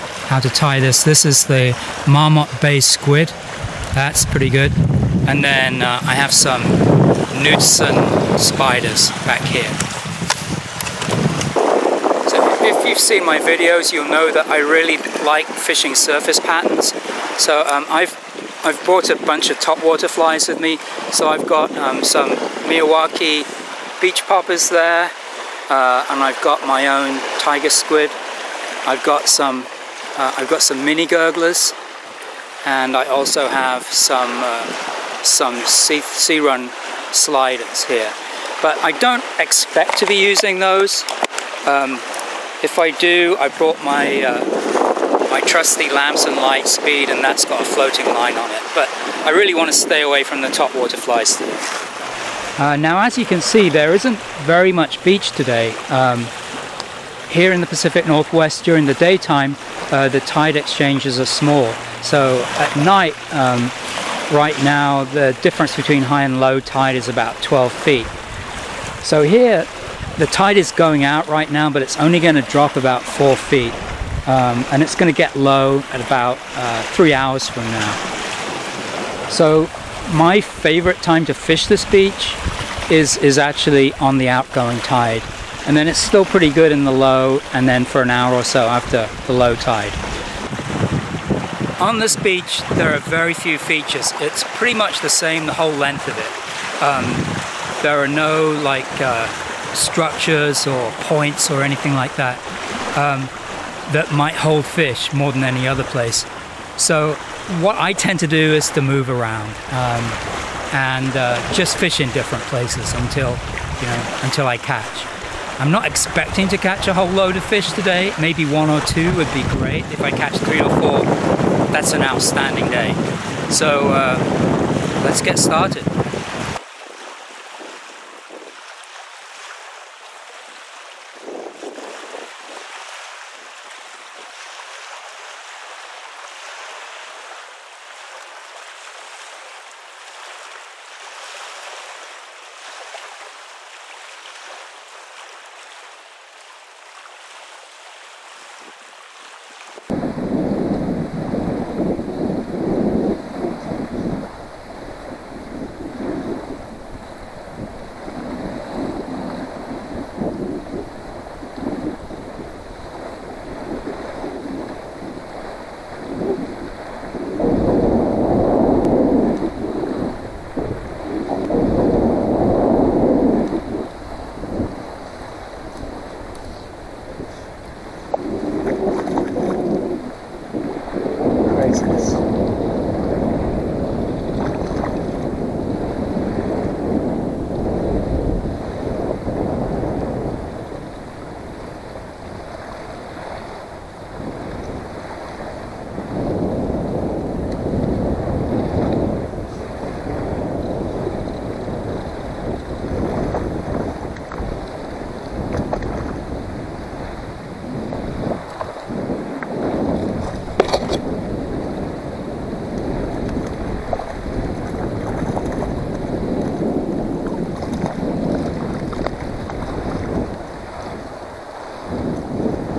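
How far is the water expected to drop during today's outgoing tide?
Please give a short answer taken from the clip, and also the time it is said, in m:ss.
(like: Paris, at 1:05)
4 feet, at 1:13.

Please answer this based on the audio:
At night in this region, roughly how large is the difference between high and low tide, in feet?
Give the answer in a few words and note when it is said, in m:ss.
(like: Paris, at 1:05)
12 feet, at 1:07.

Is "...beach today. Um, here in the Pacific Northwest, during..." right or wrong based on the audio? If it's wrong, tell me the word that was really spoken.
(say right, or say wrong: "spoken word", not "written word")
right.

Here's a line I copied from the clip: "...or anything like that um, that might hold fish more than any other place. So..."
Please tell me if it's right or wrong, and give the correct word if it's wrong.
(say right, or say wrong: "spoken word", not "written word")
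right.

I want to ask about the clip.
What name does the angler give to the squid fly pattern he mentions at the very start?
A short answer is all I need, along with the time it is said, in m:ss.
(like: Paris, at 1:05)
Marmot Bay squid, at 0:02.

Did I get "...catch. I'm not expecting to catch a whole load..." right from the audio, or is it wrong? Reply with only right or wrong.
right.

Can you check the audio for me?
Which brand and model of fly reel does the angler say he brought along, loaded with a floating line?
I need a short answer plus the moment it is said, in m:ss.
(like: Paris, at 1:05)
Lamson Litespeed, at 0:45.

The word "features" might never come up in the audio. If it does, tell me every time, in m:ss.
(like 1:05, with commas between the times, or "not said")
1:33.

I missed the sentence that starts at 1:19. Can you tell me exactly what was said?
So my favorite time to fish this beach is, is actually on the outgoing tide.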